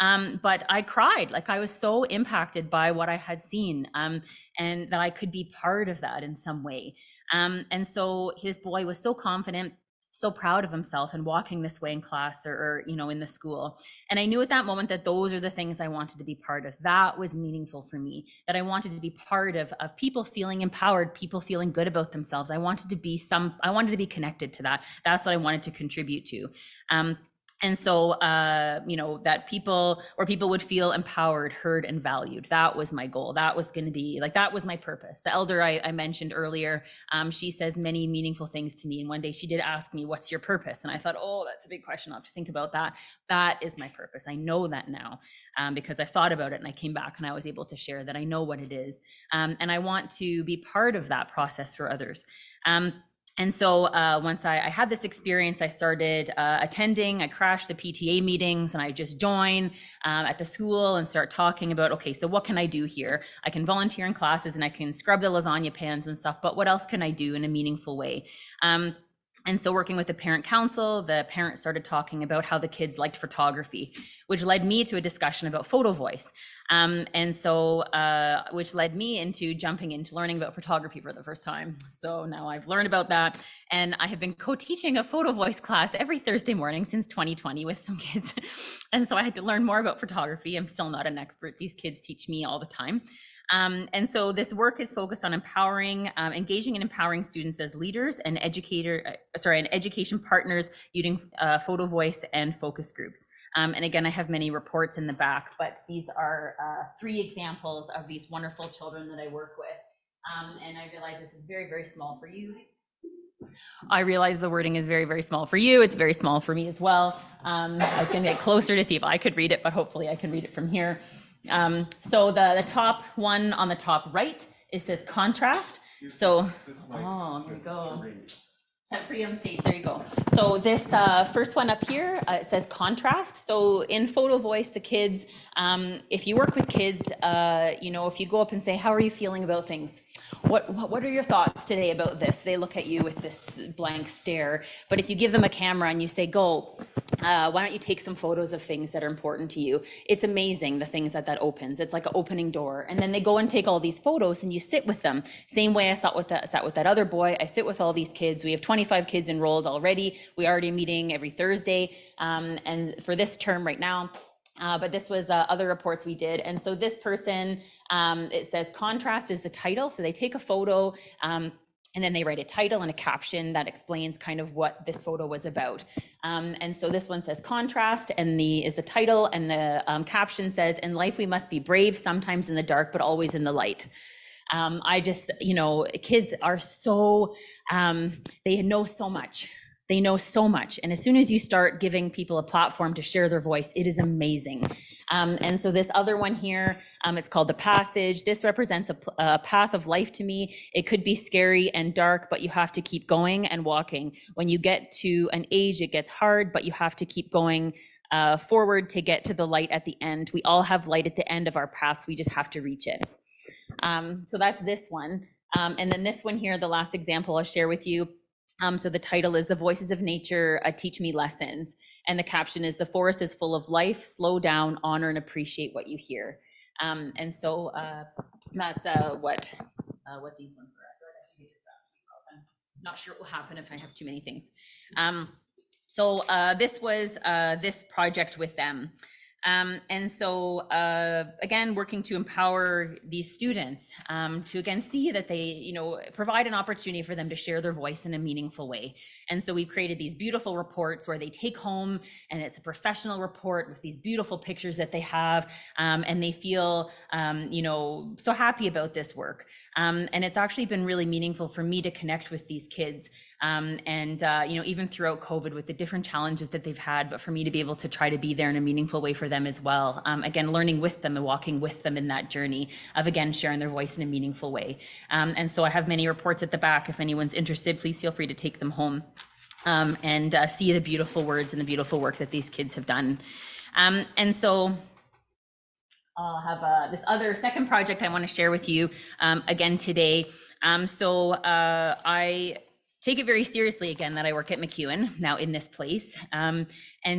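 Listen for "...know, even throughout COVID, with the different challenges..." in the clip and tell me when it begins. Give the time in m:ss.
4:24.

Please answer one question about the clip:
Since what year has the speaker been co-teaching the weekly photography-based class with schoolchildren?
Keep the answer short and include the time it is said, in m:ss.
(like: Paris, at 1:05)
2020, at 1:27.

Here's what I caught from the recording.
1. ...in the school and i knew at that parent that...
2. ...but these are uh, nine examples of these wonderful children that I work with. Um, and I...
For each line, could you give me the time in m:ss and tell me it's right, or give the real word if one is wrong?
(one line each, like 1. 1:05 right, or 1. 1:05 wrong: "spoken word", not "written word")
1. 0:13 wrong: "moment", not "parent"
2. 1:45 wrong: "three", not "nine".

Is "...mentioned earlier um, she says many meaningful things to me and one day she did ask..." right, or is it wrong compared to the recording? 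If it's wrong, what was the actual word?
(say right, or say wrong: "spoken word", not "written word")
right.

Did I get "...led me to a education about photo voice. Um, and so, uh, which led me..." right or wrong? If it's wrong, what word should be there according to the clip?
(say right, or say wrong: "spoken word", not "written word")
wrong: "discussion", not "education".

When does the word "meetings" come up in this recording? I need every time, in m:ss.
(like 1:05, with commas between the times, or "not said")
0:58, 2:40.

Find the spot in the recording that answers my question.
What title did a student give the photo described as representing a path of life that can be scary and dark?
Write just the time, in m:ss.
3:17.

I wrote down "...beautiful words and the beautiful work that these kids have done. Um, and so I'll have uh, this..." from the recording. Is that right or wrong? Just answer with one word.
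right.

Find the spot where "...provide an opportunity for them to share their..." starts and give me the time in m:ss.
4:06.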